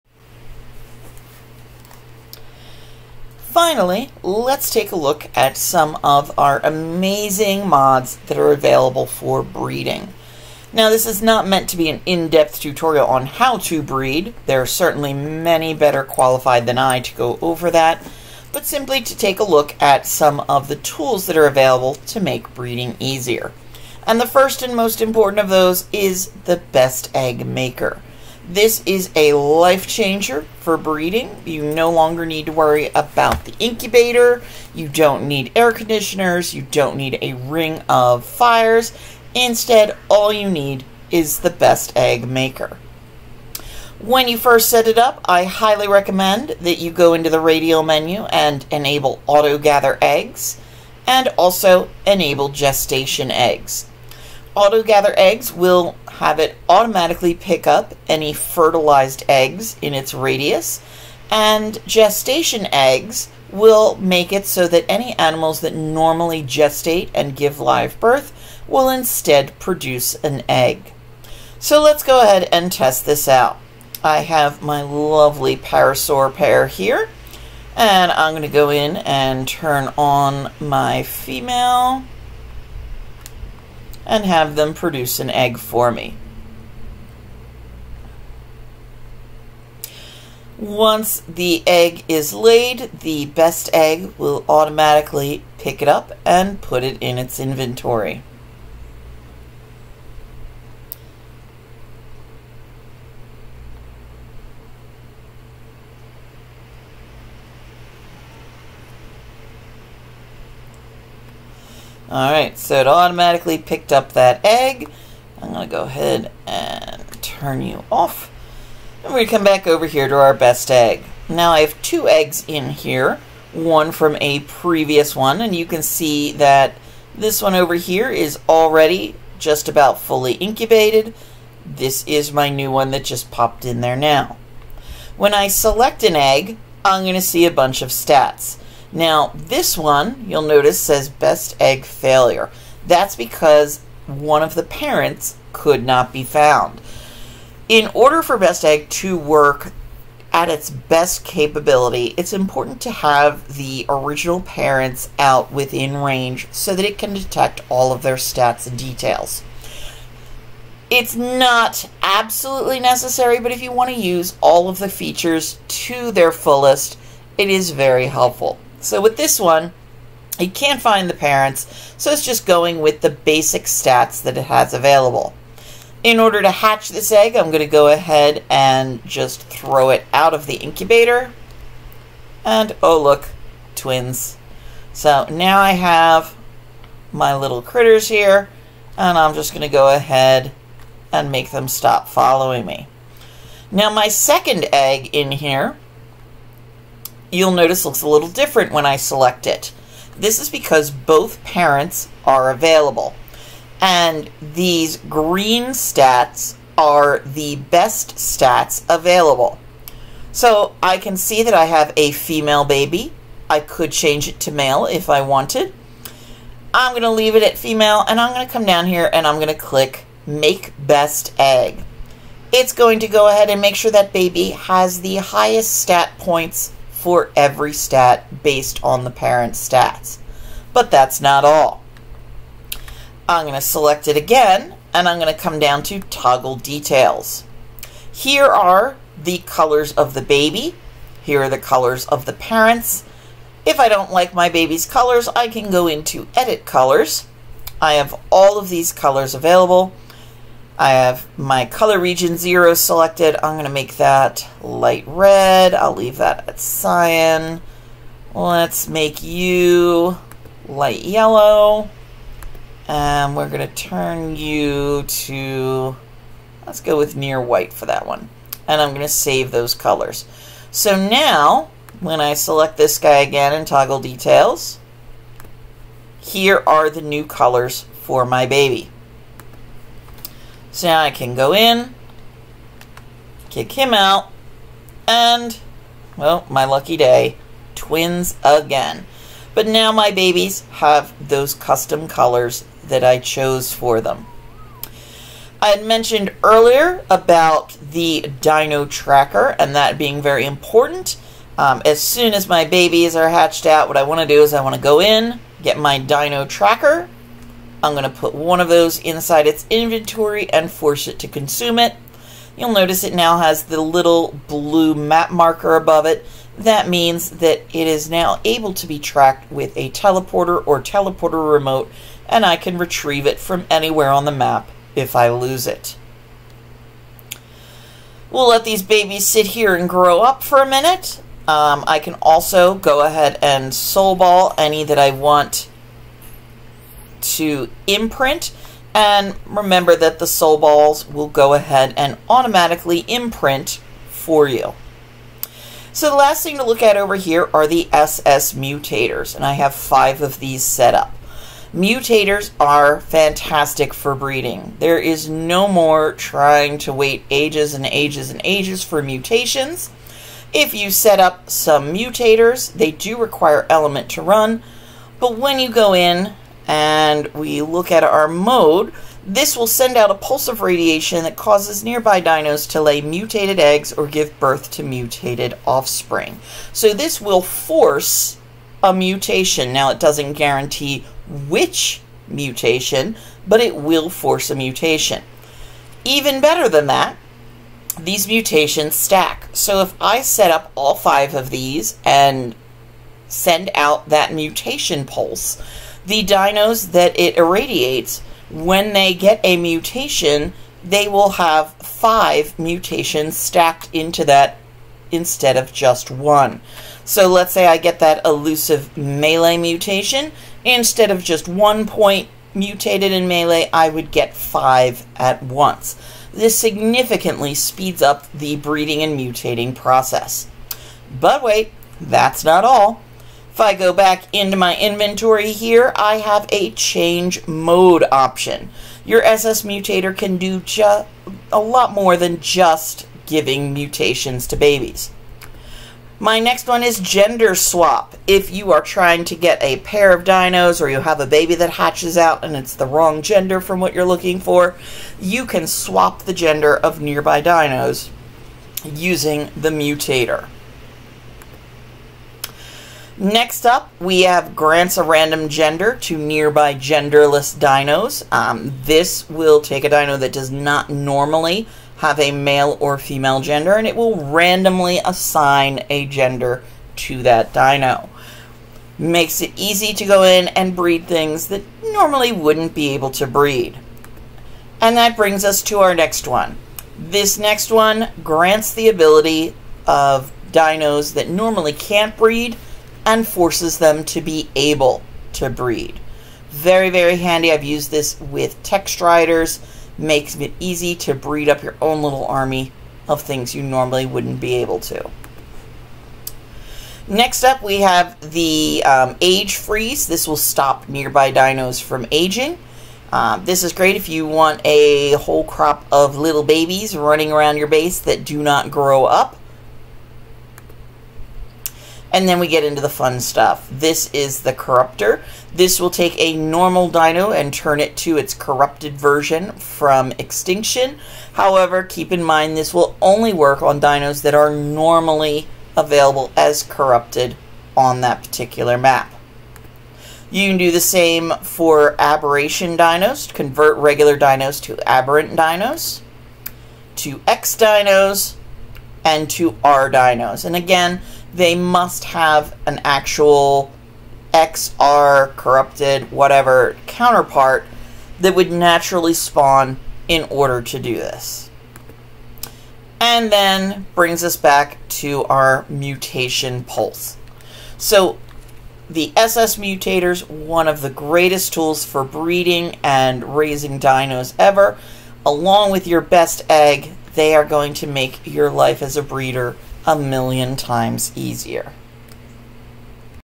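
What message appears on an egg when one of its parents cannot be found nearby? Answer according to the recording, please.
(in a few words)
best egg failure.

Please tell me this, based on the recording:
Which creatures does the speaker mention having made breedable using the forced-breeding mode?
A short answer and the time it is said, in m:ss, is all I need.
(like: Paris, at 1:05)
Tek Stryders, at 8:08.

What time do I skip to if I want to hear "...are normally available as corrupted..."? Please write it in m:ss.
8:44.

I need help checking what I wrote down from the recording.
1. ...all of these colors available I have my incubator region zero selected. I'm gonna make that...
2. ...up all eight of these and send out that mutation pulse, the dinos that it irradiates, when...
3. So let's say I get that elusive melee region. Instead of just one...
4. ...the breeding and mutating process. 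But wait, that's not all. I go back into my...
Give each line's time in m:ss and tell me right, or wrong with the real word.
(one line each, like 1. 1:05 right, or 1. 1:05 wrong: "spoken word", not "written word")
1. 4:08 wrong: "color", not "incubator"
2. 6:30 wrong: "five", not "eight"
3. 6:47 wrong: "mutation", not "region"
4. 6:58 right.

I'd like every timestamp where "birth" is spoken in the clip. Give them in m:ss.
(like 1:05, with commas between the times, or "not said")
1:08, 6:14.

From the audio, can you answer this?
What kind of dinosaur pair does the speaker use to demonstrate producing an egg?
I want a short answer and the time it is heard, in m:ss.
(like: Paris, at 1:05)
parasaur, at 1:15.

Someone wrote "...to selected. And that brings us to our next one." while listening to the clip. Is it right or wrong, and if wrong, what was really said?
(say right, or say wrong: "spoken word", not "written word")
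wrong: "breed", not "selected".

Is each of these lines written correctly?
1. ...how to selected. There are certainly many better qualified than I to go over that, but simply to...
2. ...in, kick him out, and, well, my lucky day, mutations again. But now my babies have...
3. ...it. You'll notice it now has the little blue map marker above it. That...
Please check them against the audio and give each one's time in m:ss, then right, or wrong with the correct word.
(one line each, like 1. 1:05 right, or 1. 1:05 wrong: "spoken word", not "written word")
1. 0:13 wrong: "breed", not "selected"
2. 4:41 wrong: "twins", not "mutations"
3. 5:11 right.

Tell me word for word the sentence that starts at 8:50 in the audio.
You can do the same for aberration dinos, convert regular dinos to aberrant dinos, to X dinos, and to R dinos.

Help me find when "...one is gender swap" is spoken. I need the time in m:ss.
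7:16.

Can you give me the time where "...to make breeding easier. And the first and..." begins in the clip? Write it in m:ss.
0:22.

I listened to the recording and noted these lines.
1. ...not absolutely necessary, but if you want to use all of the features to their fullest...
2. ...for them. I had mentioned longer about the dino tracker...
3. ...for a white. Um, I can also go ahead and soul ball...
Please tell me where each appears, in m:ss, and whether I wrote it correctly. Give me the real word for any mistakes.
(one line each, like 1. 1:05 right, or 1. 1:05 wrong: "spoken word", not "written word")
1. 2:41 right
2. 4:53 wrong: "earlier", not "longer"
3. 5:30 wrong: "minute", not "white".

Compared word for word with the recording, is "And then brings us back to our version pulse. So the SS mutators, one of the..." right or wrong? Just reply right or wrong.
wrong.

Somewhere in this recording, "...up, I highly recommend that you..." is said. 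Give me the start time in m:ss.
0:44.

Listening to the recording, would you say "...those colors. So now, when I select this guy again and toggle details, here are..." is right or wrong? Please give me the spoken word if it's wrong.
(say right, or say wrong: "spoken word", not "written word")
right.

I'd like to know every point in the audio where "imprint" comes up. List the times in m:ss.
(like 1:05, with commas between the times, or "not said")
5:37, 5:43.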